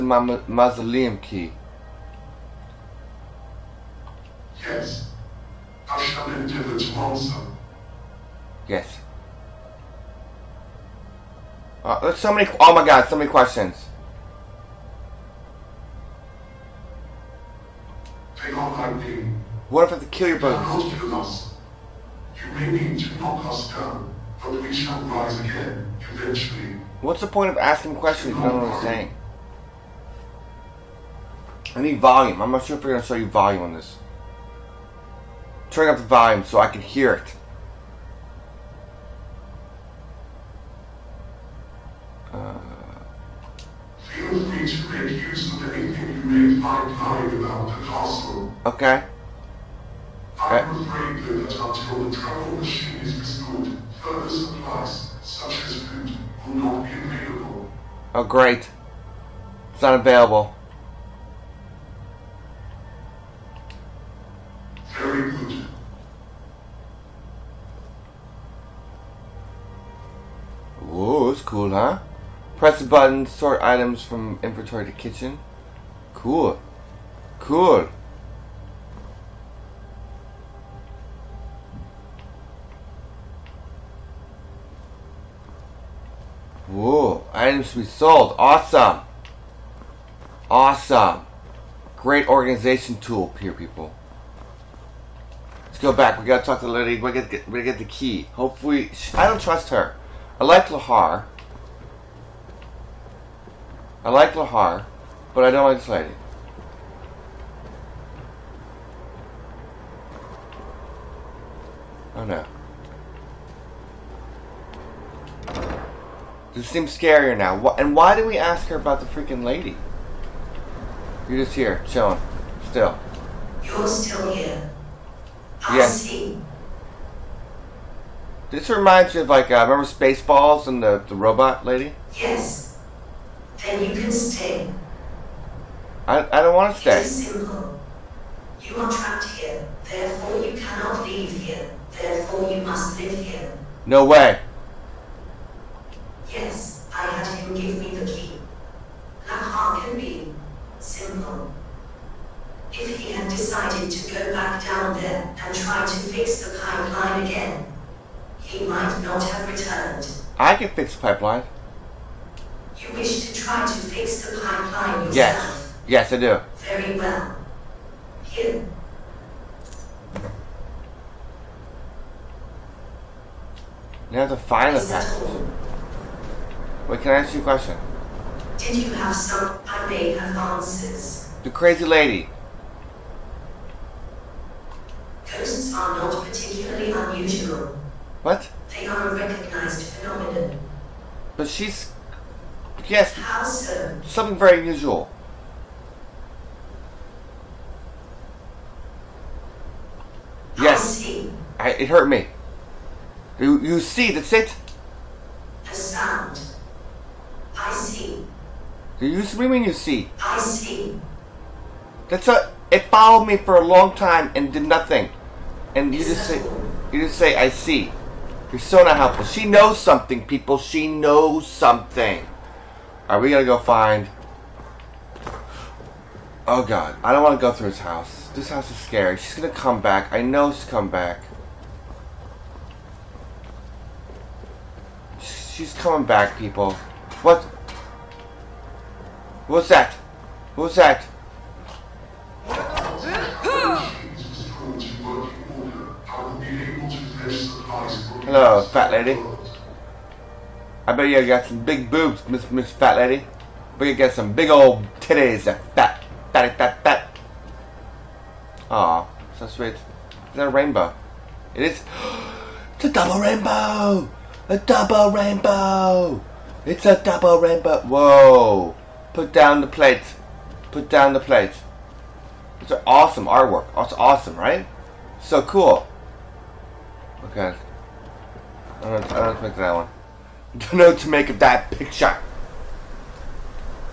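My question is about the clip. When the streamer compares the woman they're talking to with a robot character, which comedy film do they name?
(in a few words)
Spaceballs.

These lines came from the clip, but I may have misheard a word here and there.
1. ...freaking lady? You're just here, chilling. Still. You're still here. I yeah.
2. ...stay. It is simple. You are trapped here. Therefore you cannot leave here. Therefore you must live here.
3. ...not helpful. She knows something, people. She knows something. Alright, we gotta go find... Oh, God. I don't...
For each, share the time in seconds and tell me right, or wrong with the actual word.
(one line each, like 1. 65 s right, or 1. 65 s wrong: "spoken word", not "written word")
1. 119 s right
2. 136 s right
3. 218 s right.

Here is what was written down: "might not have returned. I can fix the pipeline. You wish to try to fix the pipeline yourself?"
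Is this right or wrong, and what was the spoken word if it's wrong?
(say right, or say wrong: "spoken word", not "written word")
right.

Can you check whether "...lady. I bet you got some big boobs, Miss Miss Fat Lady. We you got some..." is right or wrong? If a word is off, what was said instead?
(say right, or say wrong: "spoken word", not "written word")
right.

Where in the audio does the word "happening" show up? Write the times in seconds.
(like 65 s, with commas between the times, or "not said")
not said.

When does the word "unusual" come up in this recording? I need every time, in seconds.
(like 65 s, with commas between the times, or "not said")
186 s, 194 s.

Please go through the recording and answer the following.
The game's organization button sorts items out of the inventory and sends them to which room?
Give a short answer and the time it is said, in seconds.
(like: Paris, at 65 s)
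kitchen, at 74 s.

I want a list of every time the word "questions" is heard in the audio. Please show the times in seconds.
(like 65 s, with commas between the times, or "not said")
13 s, 27 s, 177 s.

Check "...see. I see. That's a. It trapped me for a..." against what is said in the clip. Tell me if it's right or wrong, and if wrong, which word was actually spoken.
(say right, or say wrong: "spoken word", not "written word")
wrong: "followed", not "trapped".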